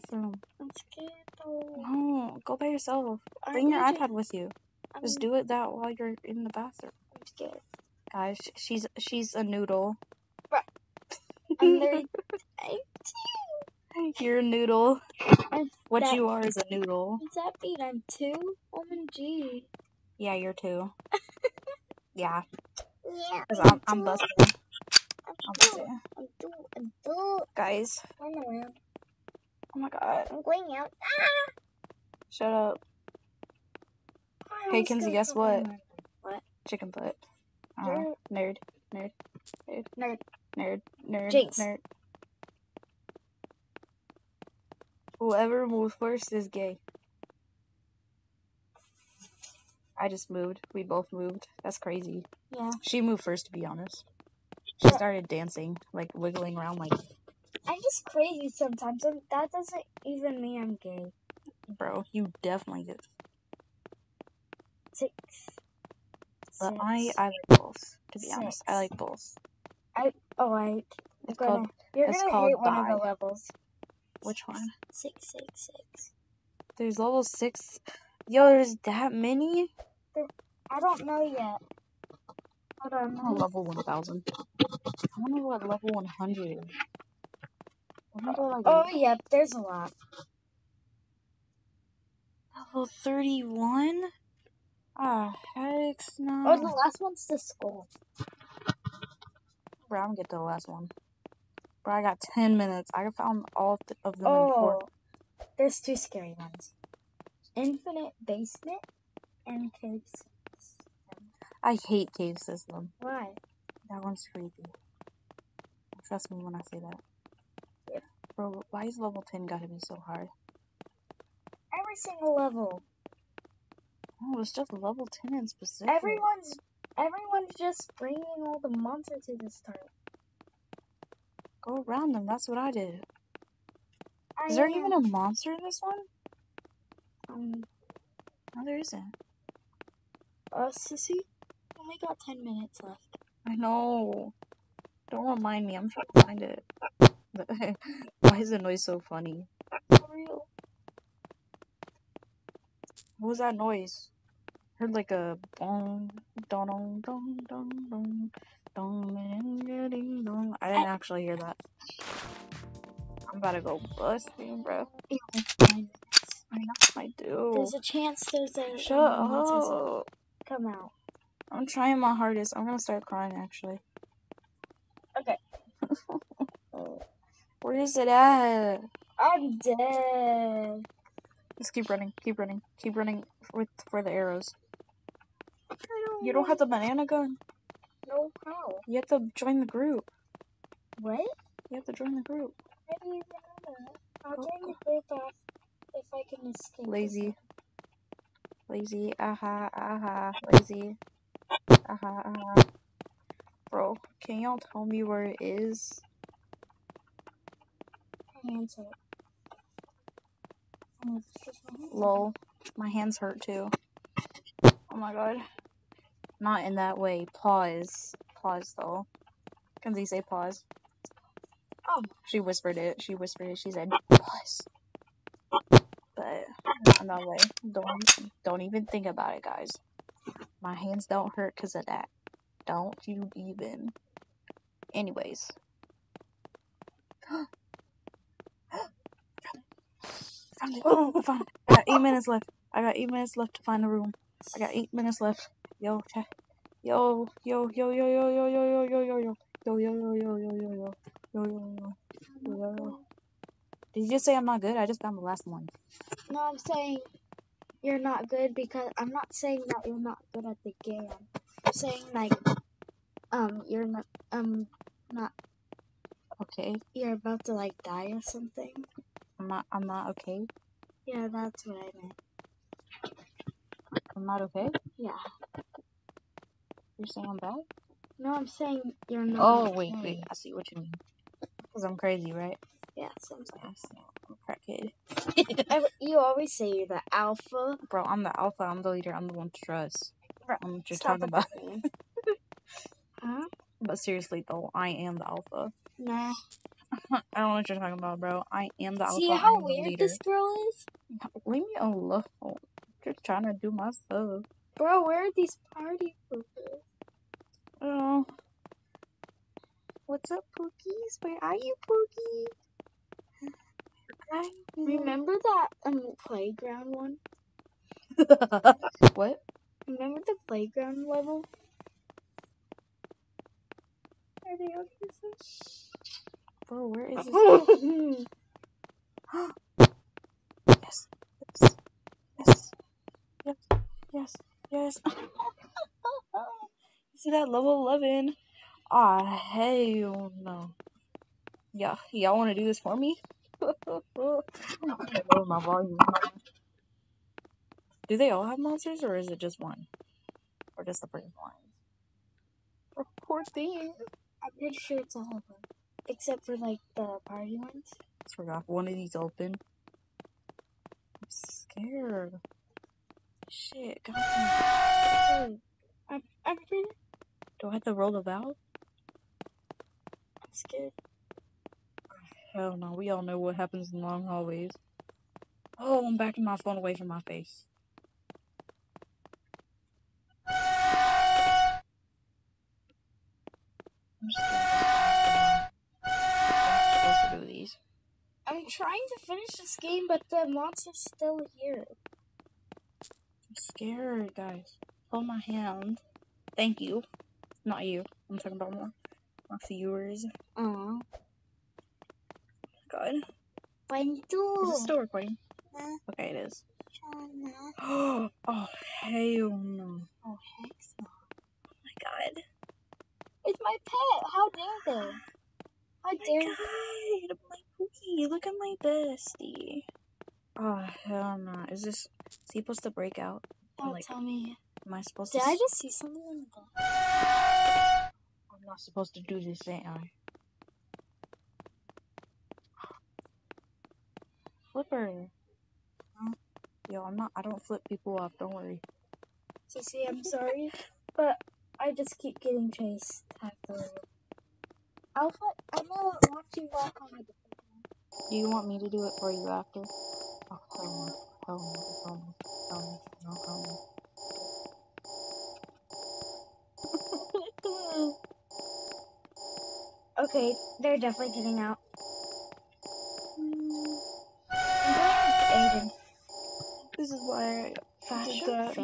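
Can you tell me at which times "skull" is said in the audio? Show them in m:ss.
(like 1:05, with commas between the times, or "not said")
1:37.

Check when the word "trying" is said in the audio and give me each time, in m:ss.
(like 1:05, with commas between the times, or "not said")
2:25, 2:51, 5:03, 6:28.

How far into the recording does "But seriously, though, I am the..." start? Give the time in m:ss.
4:53.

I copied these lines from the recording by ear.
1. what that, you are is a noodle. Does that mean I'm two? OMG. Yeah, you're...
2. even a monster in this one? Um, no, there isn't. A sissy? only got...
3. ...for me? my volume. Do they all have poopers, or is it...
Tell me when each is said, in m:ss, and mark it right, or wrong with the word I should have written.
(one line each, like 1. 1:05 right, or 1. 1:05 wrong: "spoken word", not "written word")
1. 0:15 right
2. 2:14 right
3. 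5:42 wrong: "monsters", not "poopers".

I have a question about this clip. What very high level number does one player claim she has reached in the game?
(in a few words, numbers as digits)
1000.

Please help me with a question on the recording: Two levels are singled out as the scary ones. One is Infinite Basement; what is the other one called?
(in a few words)
Caves.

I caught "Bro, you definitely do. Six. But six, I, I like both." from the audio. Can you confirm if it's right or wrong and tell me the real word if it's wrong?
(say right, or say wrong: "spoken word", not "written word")
right.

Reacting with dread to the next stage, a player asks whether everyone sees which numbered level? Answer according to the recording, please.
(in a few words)
11.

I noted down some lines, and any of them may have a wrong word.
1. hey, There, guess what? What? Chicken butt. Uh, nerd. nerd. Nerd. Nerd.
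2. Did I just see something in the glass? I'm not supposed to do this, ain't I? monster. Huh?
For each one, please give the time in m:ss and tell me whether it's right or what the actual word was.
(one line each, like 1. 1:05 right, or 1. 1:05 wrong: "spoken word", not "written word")
1. 0:34 wrong: "Kenzie", not "There"
2. 7:05 wrong: "flipper", not "monster".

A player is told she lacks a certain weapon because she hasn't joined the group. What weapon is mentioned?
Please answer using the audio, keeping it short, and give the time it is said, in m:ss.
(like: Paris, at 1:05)
banana gun, at 3:06.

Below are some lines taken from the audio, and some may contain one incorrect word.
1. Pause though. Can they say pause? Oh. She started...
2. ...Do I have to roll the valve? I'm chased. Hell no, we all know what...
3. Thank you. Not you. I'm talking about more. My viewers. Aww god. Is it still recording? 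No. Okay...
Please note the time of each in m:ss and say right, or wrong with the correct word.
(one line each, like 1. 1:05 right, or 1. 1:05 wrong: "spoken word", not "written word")
1. 3:38 wrong: "whispered", not "started"
2. 6:07 wrong: "scared", not "chased"
3. 6:36 right.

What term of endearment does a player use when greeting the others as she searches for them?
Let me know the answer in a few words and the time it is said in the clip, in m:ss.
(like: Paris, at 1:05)
Pookies, at 5:10.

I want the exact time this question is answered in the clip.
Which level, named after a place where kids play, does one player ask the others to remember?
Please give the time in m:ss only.
5:20.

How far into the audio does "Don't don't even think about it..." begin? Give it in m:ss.
3:47.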